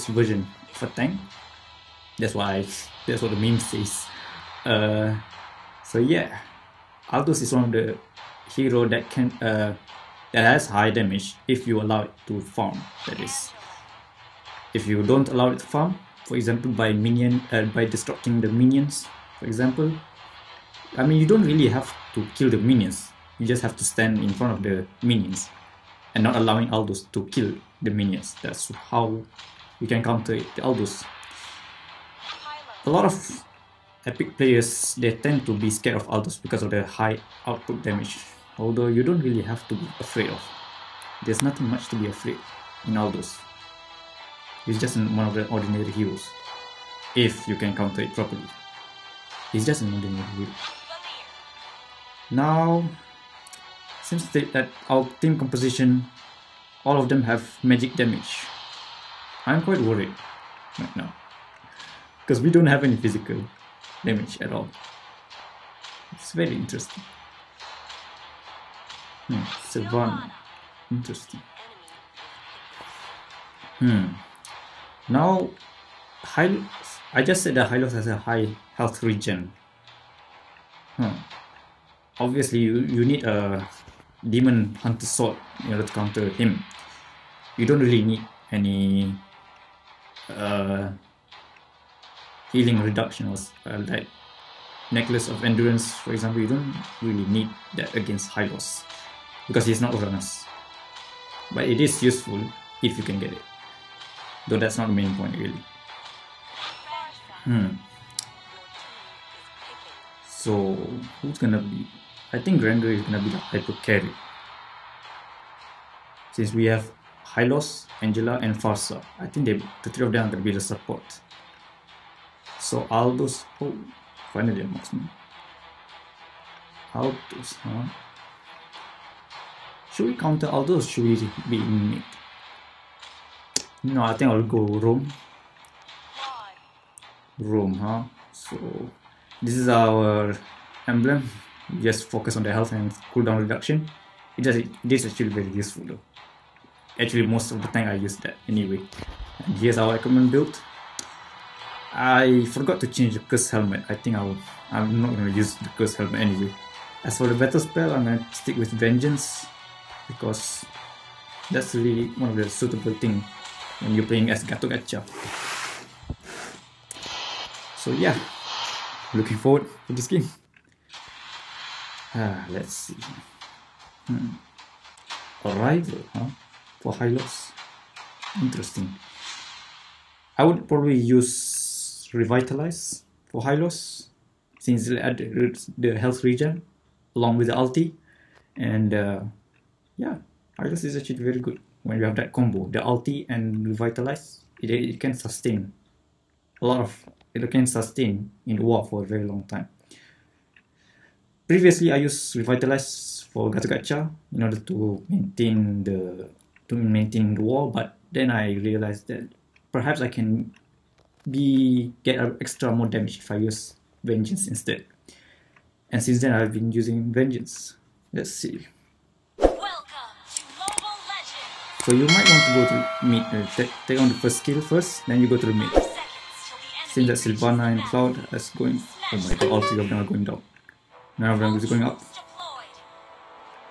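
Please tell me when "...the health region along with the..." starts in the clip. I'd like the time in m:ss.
3:04.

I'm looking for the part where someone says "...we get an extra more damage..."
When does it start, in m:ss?
3:31.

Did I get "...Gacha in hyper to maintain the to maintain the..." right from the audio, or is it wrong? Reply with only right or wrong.
wrong.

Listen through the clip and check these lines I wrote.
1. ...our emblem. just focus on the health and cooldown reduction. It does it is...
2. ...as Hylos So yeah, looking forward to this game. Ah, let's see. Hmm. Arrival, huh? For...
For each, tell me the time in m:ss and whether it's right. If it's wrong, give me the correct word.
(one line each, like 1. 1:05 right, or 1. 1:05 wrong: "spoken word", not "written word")
1. 2:19 right
2. 2:44 wrong: "Gato", not "Hylos".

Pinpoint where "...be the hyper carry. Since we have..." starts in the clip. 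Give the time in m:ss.
1:53.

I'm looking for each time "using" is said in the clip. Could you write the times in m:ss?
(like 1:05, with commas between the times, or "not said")
3:36.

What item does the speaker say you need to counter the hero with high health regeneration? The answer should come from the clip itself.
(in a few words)
Demon Hunter Sword.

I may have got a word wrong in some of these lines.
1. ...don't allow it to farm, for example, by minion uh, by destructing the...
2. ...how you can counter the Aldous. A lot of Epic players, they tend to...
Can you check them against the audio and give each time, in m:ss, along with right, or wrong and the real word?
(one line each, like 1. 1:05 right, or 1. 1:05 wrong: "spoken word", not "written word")
1. 0:15 right
2. 0:28 right.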